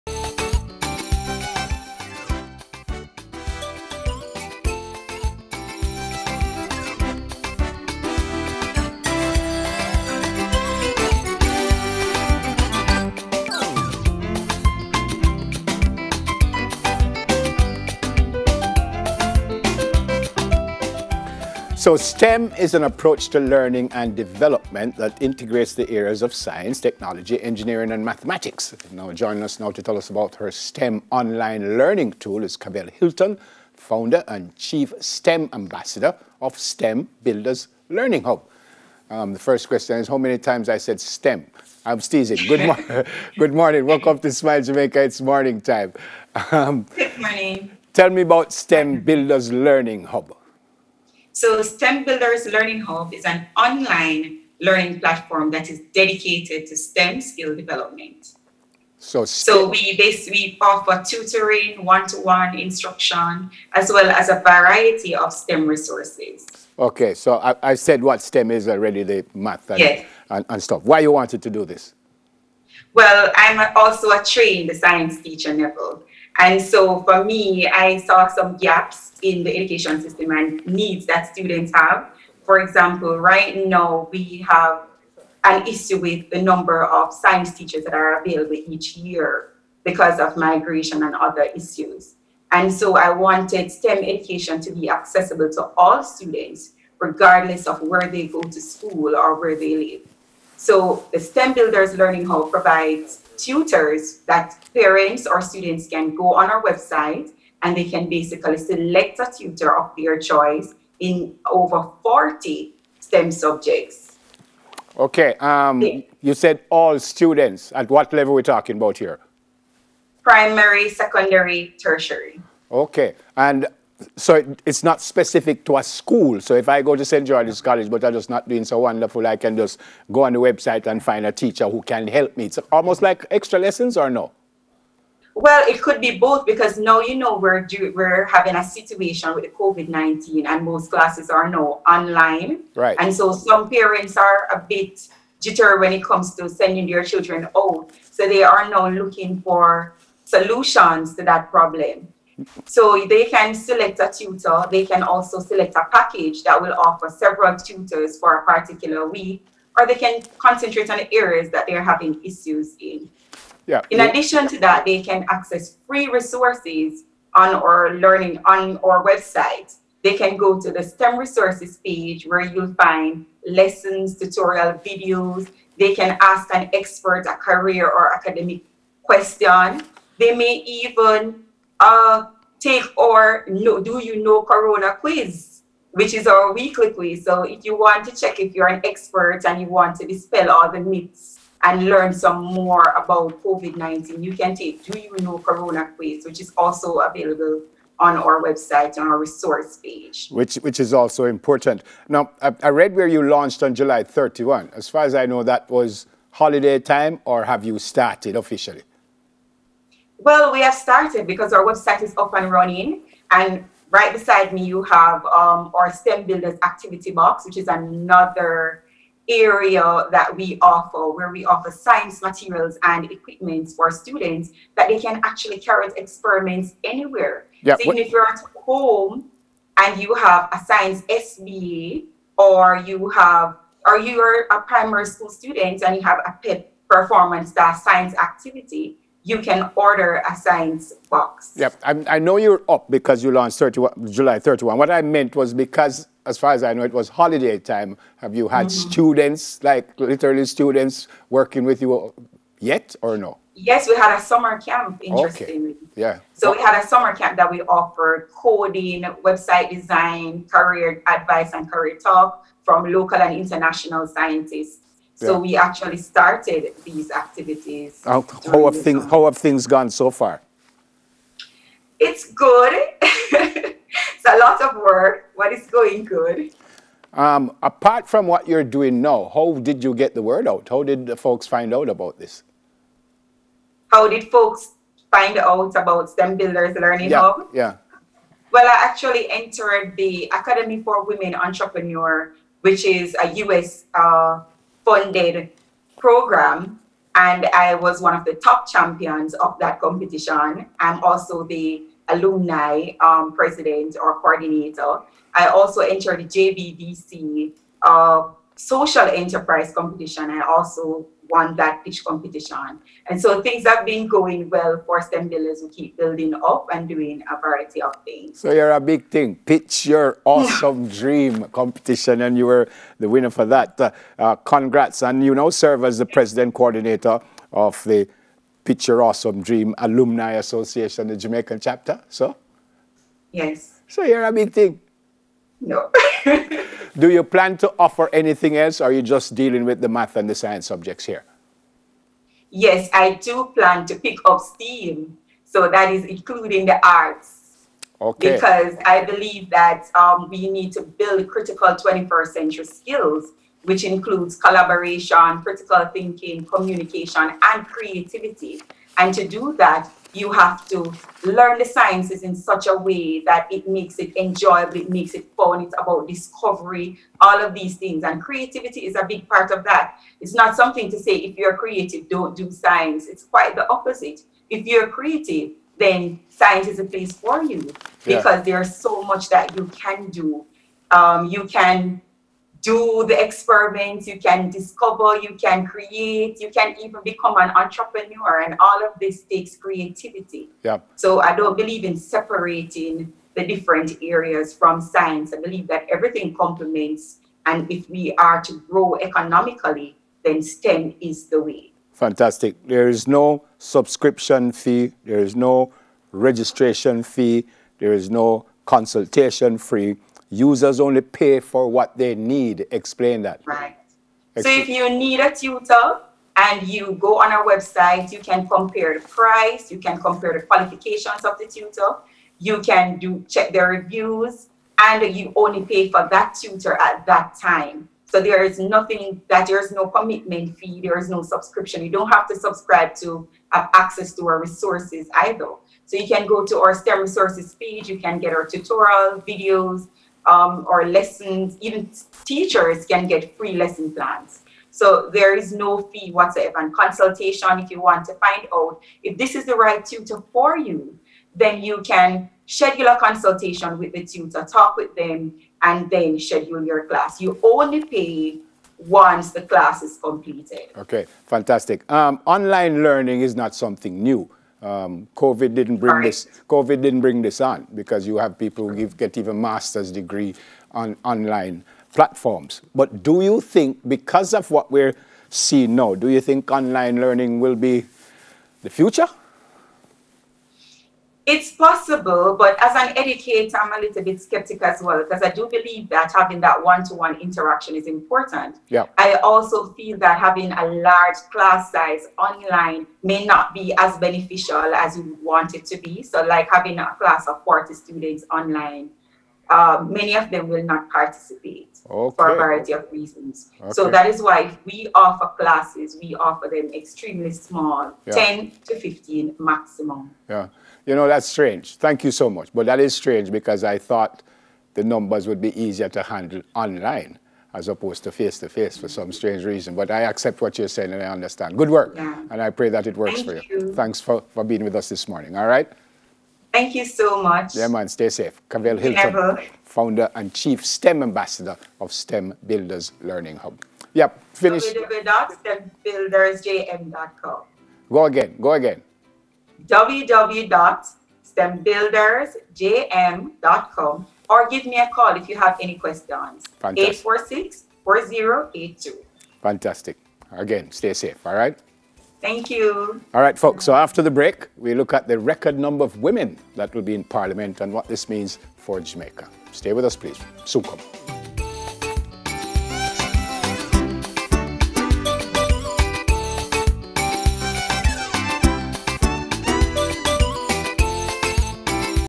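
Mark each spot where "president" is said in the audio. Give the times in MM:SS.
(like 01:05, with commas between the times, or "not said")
05:03, 05:26.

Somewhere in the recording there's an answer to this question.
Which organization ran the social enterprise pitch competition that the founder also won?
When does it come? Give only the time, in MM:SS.
05:06.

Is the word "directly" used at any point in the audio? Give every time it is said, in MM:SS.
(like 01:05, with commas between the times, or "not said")
not said.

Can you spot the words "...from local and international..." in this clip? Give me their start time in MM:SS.
04:22.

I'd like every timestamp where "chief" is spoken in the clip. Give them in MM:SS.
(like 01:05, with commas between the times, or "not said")
00:34, 08:50.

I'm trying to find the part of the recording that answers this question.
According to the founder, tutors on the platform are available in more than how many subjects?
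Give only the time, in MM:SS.
01:51.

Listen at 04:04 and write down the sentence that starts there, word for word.
What I meant was because, as far as I know, it was holiday time.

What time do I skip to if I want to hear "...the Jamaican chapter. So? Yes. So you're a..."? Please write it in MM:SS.
05:31.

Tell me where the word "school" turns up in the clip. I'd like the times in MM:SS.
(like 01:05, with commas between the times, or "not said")
01:38, 02:05, 03:55.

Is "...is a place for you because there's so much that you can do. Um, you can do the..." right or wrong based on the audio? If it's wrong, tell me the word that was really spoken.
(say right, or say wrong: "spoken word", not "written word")
right.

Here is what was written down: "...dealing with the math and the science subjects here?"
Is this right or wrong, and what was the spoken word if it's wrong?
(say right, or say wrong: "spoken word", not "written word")
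right.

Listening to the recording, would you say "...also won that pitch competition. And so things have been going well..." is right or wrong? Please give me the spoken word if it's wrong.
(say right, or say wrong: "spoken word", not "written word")
right.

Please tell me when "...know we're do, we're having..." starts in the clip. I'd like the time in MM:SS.
02:17.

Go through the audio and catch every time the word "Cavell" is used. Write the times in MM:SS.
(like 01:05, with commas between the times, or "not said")
00:32, 08:48.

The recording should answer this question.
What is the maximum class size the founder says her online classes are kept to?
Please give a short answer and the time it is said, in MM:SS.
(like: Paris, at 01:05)
15, at 08:28.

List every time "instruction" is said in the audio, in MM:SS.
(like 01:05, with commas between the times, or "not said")
01:02.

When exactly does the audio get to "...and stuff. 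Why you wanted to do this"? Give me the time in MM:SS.
01:10.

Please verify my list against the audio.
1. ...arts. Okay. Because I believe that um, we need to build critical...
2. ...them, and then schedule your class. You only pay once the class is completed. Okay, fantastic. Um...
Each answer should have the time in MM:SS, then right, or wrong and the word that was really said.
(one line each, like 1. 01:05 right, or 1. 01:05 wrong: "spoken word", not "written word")
1. 05:46 right
2. 07:34 right.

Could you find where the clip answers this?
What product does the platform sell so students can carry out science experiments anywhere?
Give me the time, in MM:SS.
03:35.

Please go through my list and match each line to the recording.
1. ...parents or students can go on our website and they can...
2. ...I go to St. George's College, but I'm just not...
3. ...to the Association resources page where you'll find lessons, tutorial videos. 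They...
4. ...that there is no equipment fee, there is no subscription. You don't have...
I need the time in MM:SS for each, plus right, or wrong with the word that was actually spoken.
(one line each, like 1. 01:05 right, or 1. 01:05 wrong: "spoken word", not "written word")
1. 01:44 right
2. 02:06 right
3. 02:50 wrong: "STEM", not "Association"
4. 07:09 wrong: "commitment", not "equipment".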